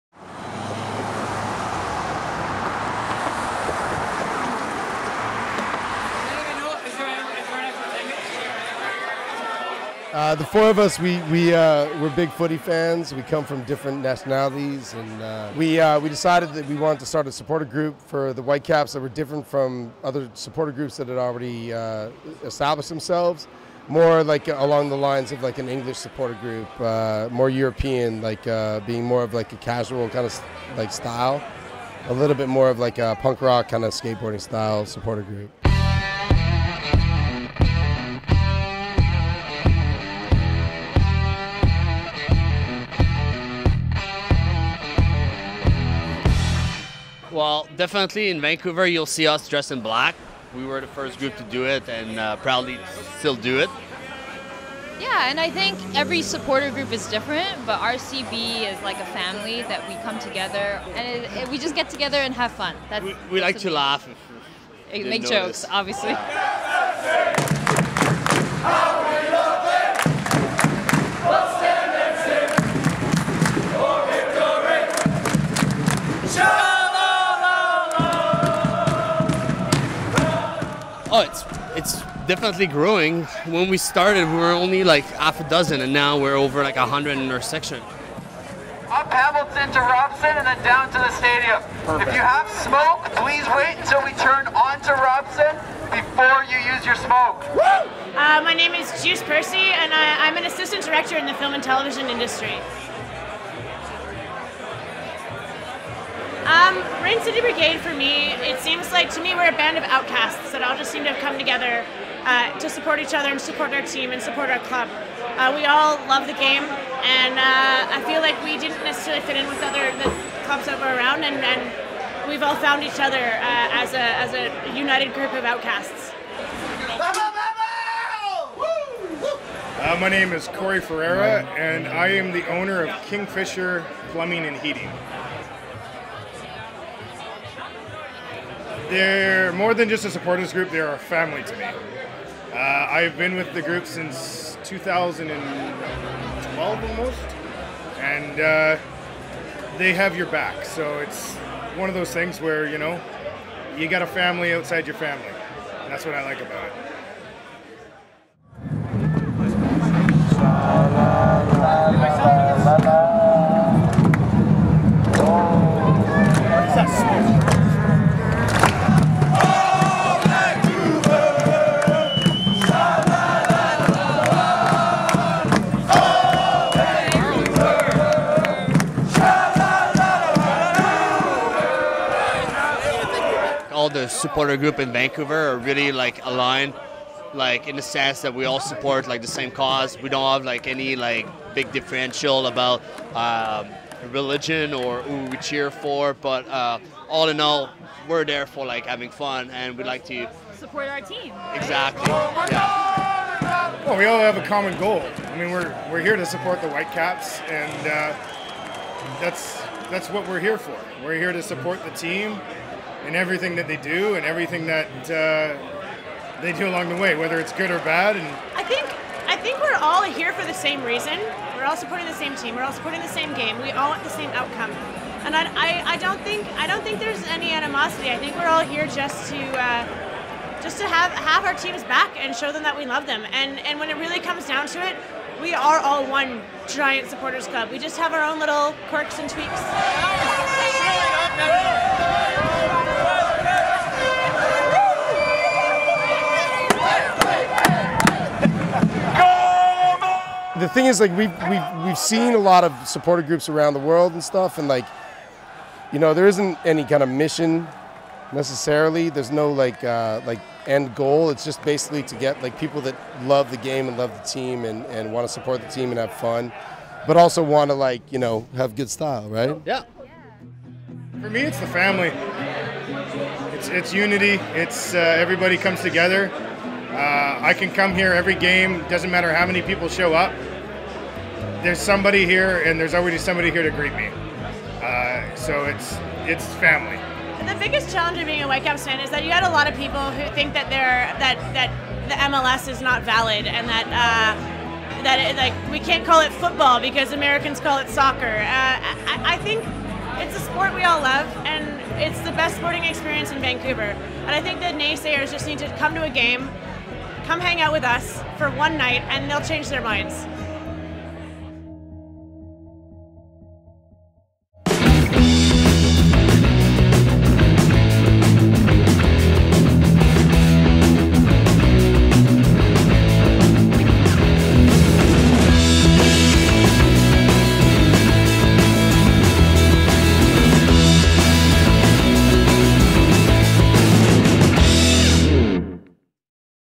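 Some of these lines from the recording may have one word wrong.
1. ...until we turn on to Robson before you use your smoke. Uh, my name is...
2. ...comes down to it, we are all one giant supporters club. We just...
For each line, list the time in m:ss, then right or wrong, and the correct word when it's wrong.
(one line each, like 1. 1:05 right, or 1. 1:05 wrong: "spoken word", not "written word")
1. 1:33 right
2. 3:54 right.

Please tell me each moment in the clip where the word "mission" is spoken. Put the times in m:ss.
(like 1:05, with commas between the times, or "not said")
4:17.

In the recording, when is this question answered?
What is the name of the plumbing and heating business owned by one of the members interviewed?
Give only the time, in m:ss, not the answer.
2:13.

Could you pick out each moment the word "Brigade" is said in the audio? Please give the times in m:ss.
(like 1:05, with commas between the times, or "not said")
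1:47.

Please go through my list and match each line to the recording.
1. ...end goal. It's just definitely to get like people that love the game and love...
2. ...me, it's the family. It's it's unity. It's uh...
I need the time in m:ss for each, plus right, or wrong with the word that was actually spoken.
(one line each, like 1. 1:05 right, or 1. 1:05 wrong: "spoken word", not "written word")
1. 4:20 wrong: "basically", not "definitely"
2. 4:31 right.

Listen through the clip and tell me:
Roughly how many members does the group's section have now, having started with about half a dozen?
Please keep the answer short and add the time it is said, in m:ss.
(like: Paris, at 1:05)
over 100, at 1:26.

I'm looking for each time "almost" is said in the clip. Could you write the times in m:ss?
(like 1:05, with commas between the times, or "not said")
2:26.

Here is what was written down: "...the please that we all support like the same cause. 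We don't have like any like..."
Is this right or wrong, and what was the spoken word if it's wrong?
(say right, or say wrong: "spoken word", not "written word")
wrong: "sense", not "please".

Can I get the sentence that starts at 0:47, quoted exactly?
Well, definitely in Vancouver, you'll see us dressed in black.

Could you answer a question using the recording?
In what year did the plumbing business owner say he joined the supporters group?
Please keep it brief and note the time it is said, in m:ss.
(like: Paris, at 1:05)
2012, at 2:24.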